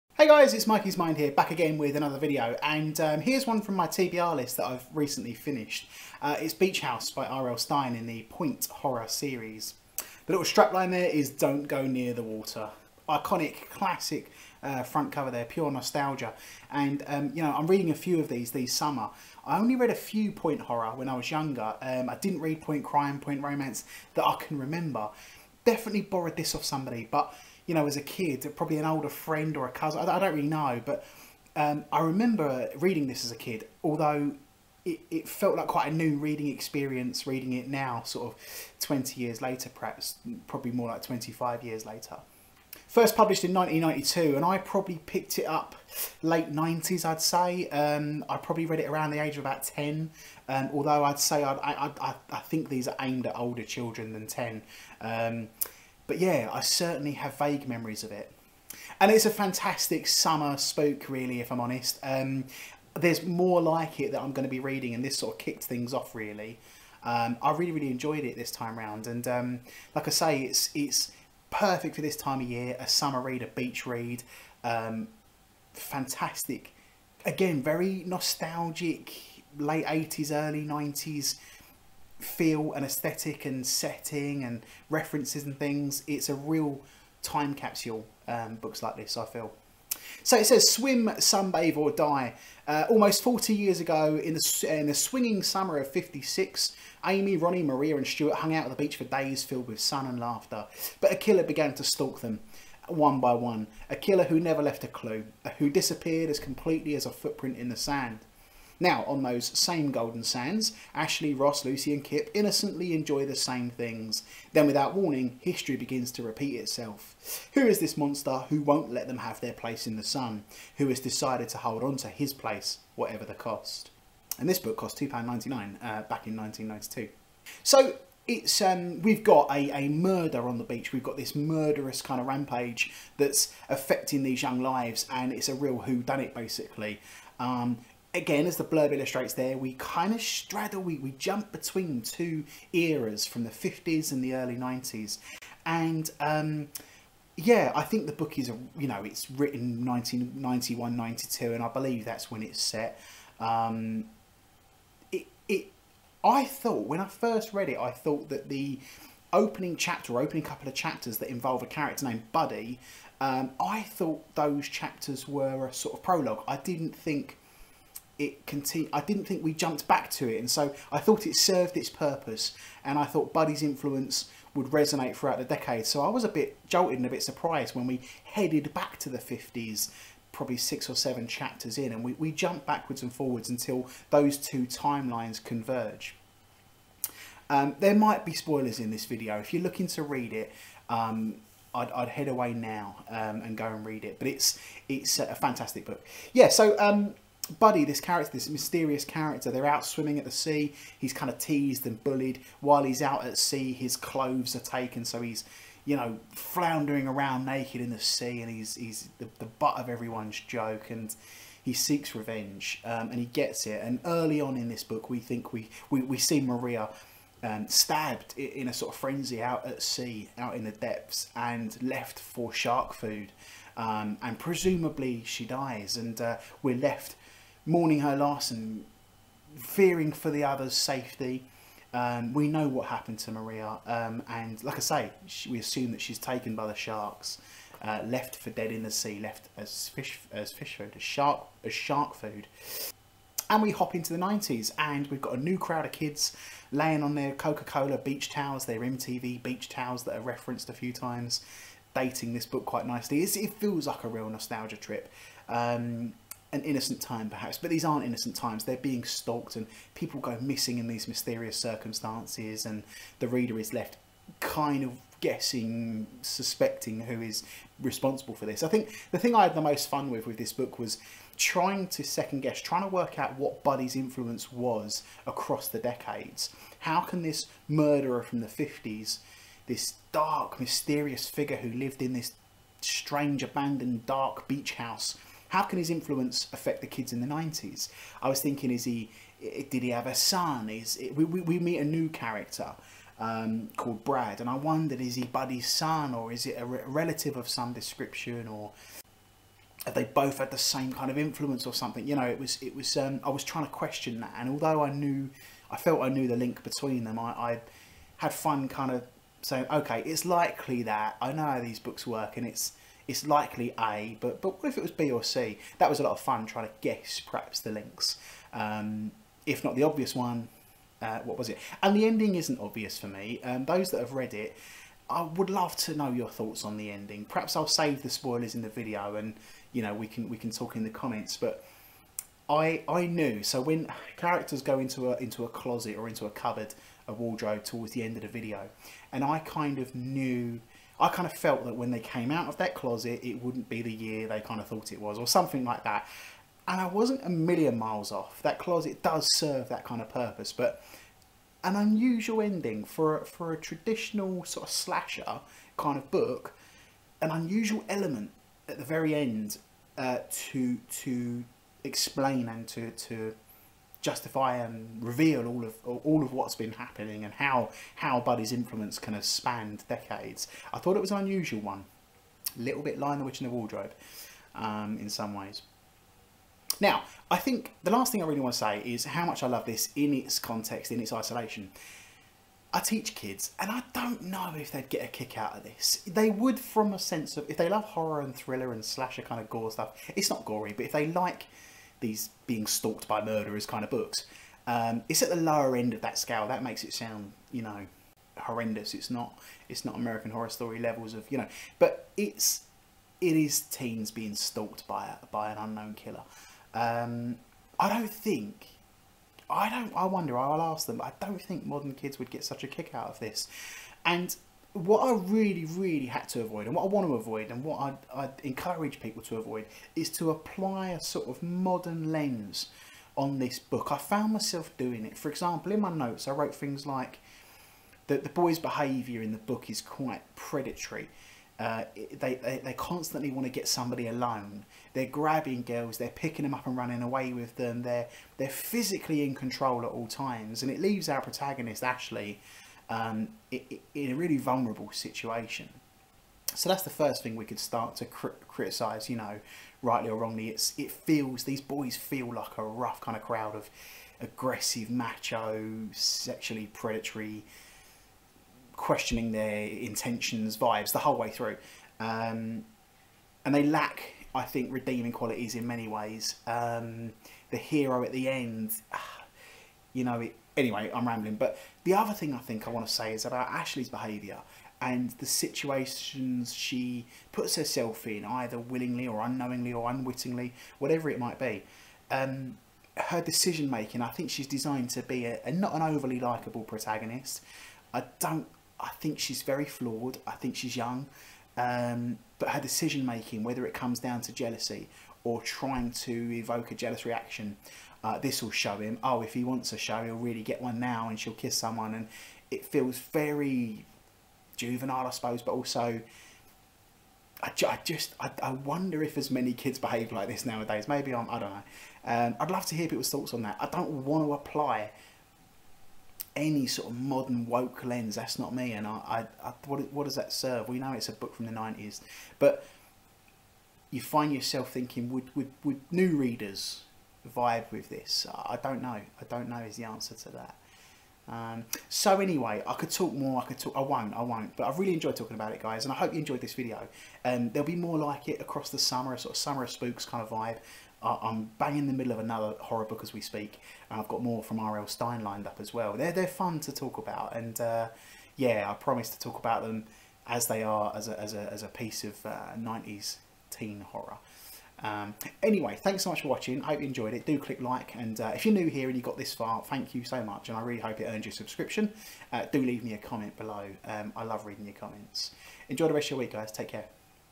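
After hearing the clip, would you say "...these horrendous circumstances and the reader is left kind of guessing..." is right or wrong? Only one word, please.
wrong.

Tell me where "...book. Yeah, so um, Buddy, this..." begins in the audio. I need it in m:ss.
3:15.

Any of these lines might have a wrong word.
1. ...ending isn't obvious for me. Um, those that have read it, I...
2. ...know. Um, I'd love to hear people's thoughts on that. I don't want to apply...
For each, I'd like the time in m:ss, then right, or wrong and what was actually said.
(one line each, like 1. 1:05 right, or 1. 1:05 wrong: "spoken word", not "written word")
1. 5:22 right
2. 8:31 right.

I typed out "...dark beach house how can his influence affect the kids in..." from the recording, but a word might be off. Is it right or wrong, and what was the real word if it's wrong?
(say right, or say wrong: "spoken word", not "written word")
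right.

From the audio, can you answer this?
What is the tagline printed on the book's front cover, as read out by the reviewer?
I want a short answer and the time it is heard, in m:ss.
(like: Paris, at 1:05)
Don't Go Near the Water, at 0:11.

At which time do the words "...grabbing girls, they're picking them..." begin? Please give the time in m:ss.
7:15.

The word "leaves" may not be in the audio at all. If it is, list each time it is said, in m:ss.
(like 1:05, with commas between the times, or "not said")
7:20, 9:22.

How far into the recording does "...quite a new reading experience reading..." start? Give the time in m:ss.
0:35.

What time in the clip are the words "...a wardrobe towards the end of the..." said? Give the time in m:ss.
5:37.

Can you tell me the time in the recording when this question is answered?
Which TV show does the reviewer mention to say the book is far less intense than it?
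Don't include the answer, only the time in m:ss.
6:39.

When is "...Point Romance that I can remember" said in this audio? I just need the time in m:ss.
0:23.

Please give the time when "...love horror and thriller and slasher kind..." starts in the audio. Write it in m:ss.
6:27.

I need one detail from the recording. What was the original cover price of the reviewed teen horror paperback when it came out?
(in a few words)
£2.99.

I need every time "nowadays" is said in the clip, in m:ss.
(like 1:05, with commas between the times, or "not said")
8:30.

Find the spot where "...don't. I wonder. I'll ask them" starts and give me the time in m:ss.
6:49.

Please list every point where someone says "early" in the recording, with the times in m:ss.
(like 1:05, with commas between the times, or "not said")
1:20, 2:24, 3:34.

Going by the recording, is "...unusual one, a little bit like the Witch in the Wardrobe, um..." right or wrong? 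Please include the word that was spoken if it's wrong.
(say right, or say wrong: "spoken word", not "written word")
right.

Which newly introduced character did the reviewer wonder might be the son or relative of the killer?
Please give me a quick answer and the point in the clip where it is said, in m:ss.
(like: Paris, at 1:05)
Brad, at 4:54.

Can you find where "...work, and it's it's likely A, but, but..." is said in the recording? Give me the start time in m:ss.
5:12.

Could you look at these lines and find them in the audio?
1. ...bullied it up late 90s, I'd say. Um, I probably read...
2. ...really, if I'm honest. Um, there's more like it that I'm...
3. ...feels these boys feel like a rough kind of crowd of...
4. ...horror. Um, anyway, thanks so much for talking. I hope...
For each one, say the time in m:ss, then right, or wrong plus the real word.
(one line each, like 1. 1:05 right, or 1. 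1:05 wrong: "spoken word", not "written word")
1. 0:45 wrong: "picked", not "bullied"
2. 1:01 right
3. 7:30 right
4. 9:13 wrong: "watching", not "talking".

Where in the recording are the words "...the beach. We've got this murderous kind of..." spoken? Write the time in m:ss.
2:10.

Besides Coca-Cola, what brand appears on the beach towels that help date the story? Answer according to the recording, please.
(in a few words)
MTV.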